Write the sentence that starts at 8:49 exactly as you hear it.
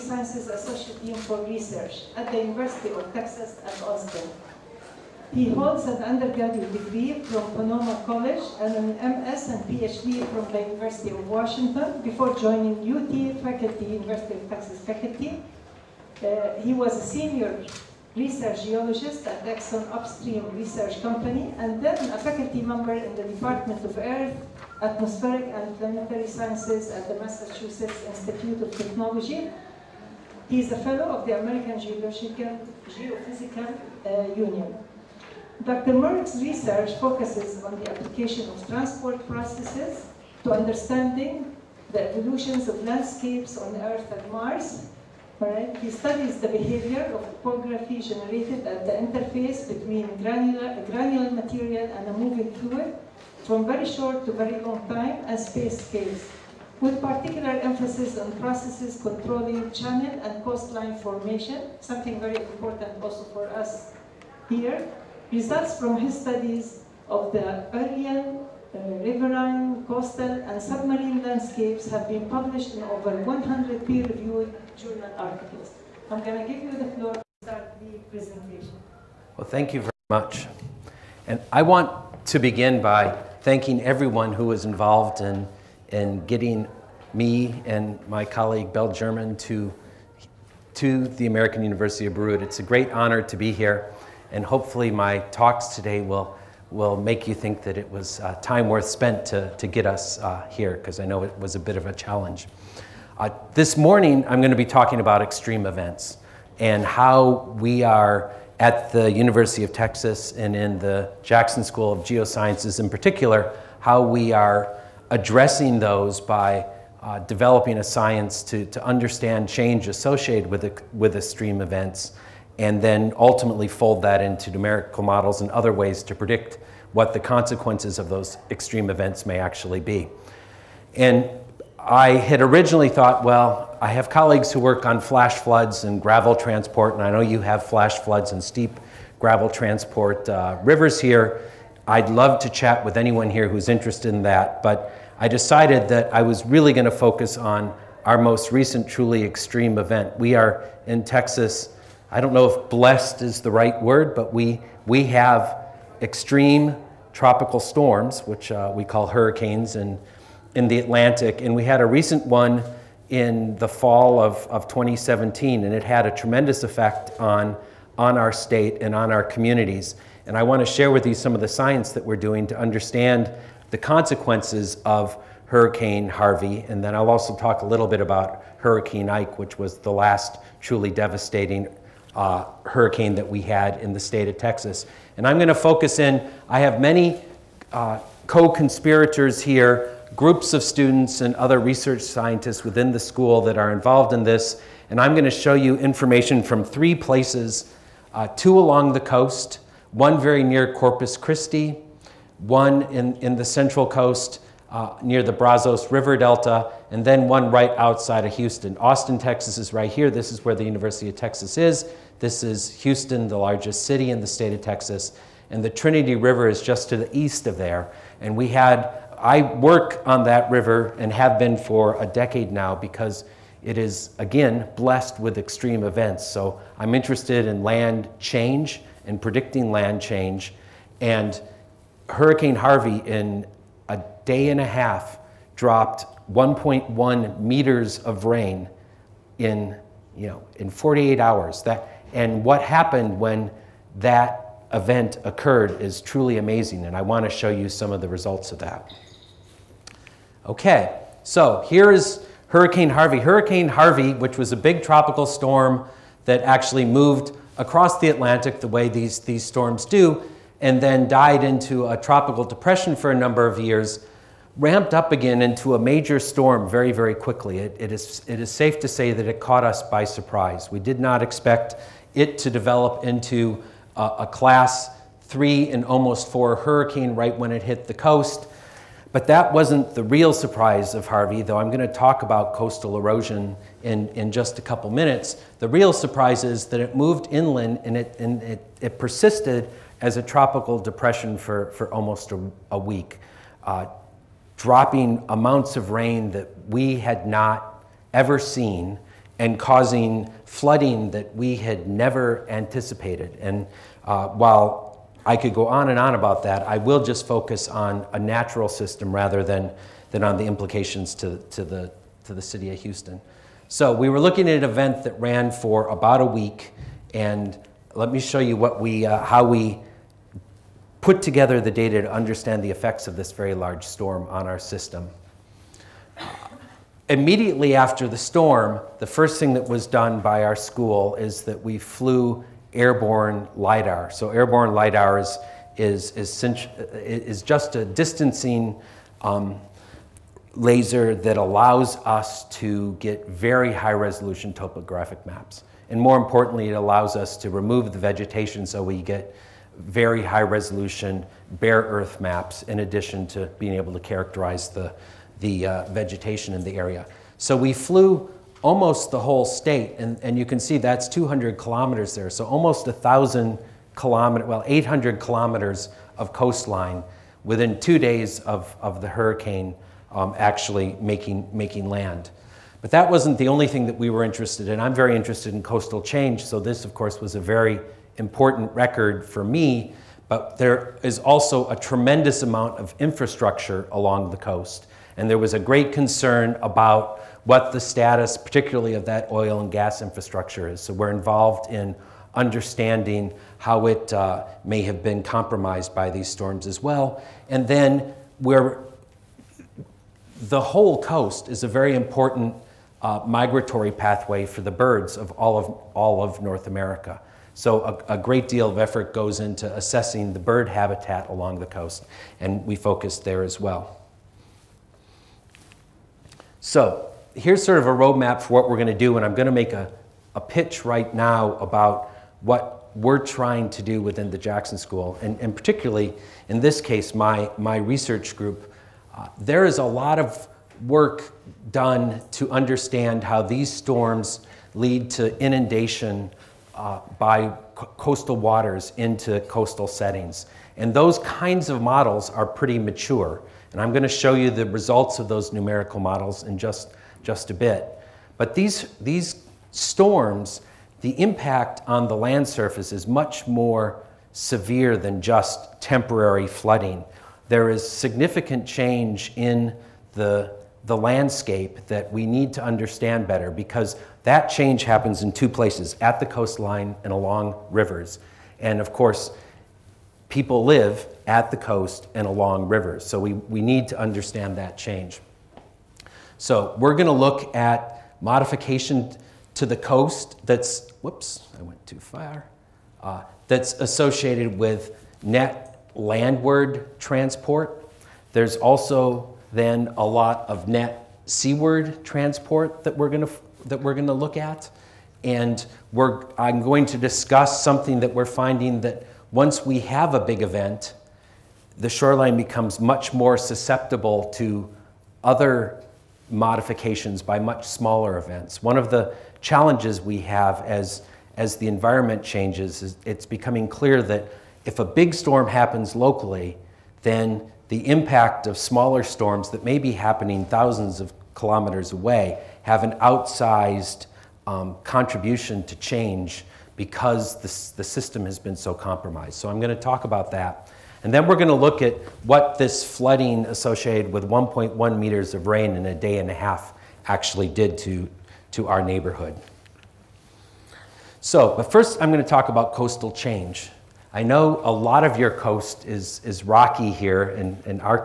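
So I'm going to talk about that.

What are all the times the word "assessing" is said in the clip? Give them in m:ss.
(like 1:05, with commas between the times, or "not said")
6:49.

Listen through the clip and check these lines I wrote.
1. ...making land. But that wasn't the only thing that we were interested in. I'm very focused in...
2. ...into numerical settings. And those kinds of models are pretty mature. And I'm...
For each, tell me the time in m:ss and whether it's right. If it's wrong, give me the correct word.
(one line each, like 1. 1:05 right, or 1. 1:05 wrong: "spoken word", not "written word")
1. 6:11 wrong: "interested", not "focused"
2. 7:18 wrong: "coastal", not "numerical".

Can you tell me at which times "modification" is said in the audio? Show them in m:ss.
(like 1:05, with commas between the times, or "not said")
7:58, 8:26.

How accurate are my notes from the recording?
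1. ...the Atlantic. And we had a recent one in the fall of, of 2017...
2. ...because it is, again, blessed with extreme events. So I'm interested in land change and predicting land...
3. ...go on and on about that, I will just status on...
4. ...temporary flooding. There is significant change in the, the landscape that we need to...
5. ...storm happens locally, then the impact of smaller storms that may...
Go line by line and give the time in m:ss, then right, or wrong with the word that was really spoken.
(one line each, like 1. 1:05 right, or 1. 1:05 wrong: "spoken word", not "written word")
1. 2:40 right
2. 3:42 right
3. 5:05 wrong: "focus", not "status"
4. 7:35 right
5. 8:35 right.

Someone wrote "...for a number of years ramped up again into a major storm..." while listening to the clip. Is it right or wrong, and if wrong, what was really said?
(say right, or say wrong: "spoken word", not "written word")
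right.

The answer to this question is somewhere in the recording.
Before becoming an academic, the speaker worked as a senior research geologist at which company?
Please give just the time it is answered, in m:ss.
0:19.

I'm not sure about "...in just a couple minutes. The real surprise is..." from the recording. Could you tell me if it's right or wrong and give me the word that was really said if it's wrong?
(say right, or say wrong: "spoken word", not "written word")
right.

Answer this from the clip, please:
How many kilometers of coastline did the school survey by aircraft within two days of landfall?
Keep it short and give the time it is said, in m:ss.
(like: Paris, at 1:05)
800 kilometers, at 6:04.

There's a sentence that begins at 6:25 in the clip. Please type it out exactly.
And there was a great concern about what the status, particularly of that oil and gas infrastructure, is.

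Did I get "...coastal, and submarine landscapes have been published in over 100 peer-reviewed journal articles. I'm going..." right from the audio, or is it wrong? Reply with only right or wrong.
right.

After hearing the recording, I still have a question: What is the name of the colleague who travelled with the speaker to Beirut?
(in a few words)
Bell German.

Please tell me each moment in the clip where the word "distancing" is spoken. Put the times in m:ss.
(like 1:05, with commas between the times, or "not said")
5:37.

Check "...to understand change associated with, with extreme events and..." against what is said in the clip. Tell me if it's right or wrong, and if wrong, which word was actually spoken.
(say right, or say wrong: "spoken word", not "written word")
right.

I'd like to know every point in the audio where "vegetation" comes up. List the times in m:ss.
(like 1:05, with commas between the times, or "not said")
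5:47, 5:55.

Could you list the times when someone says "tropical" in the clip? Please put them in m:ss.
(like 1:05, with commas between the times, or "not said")
2:37, 4:14, 4:21, 4:50.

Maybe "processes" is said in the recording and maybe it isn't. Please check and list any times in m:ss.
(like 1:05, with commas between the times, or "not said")
0:39, 0:58.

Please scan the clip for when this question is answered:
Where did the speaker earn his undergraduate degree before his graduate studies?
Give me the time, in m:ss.
0:07.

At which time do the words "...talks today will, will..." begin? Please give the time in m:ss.
1:35.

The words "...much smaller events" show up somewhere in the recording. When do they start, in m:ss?
8:27.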